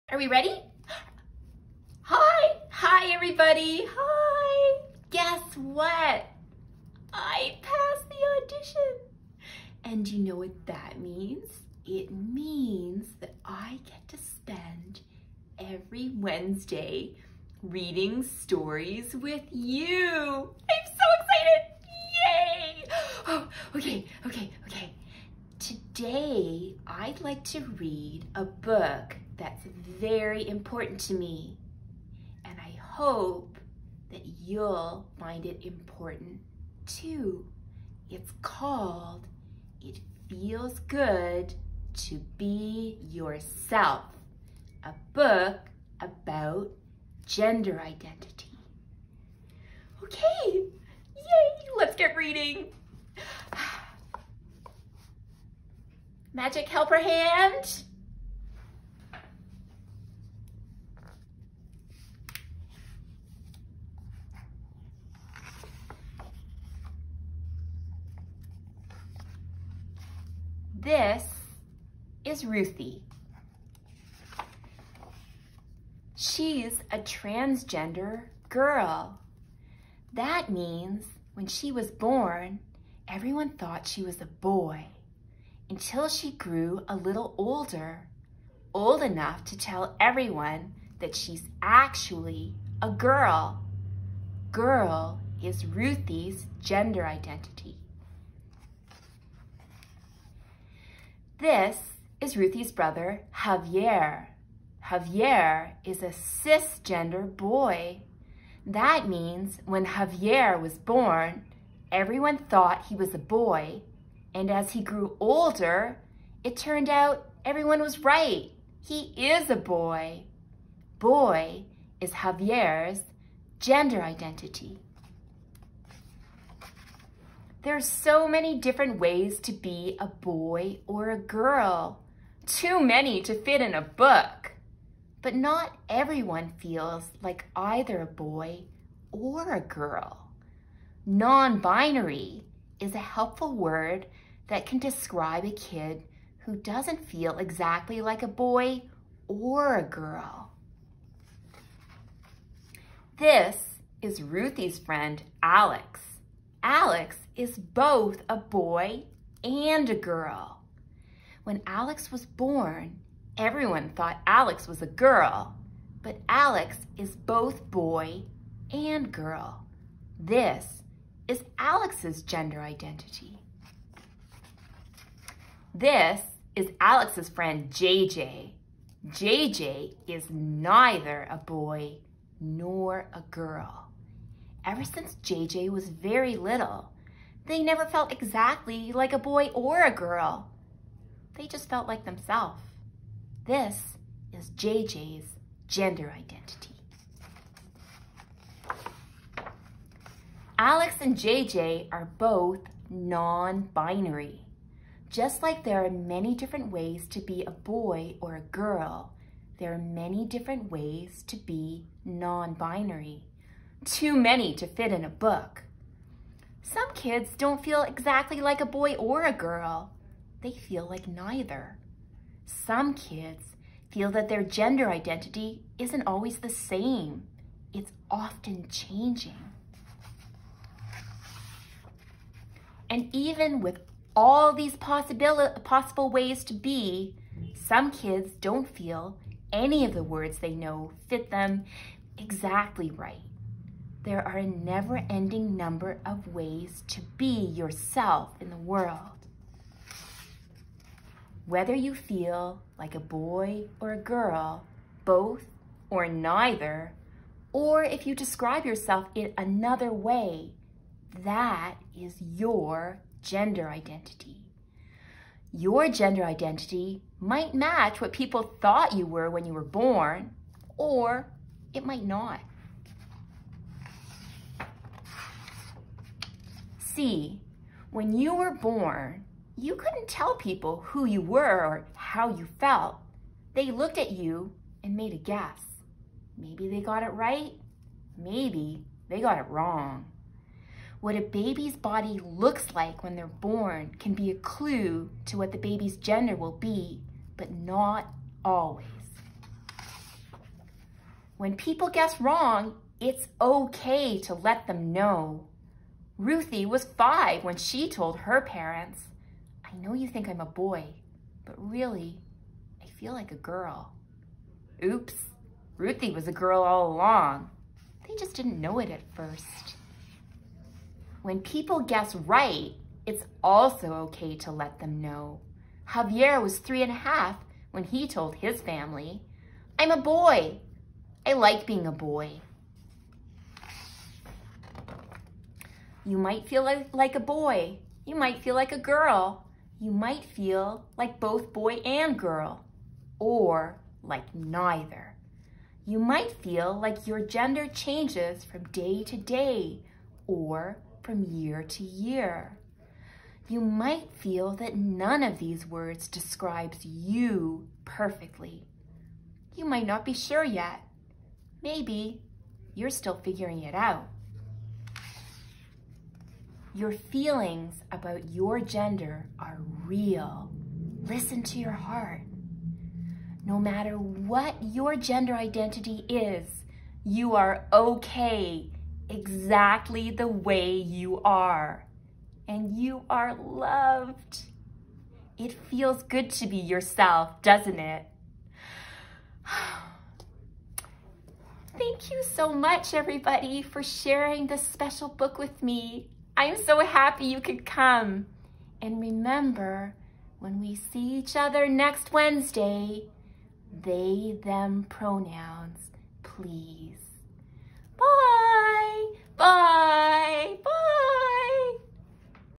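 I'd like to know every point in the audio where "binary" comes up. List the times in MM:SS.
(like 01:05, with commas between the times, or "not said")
02:21, 03:22, 03:32.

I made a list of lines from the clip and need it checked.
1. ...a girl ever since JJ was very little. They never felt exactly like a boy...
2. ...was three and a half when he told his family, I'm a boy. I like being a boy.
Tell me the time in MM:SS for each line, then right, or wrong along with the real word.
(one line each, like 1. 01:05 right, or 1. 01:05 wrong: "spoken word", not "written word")
1. 03:03 right
2. 05:26 right.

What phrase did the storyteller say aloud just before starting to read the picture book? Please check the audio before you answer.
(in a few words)
Magic helper hand.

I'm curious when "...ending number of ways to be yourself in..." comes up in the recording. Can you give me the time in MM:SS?
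04:05.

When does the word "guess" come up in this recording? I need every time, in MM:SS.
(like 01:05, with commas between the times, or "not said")
00:05, 04:45, 05:01, 05:21.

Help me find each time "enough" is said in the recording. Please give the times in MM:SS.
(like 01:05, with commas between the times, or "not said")
01:29.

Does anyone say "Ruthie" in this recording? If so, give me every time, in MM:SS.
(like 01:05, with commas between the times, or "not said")
01:12, 01:35, 01:42, 02:34, 05:06, 05:15.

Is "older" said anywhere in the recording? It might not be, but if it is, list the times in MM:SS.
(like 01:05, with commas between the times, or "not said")
01:27, 01:55.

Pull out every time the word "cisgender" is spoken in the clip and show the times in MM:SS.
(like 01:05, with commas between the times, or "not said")
01:46.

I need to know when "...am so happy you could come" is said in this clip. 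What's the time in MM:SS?
06:36.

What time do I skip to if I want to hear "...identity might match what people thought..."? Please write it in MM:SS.
04:26.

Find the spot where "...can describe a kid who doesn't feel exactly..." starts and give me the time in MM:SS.
02:24.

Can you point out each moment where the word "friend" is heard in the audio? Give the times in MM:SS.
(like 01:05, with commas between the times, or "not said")
02:34, 02:57.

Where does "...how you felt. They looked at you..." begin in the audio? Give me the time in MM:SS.
04:41.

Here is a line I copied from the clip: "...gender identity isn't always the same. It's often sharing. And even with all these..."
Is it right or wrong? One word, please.
wrong.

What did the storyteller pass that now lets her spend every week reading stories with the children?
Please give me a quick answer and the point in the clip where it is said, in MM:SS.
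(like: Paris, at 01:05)
audition, at 00:08.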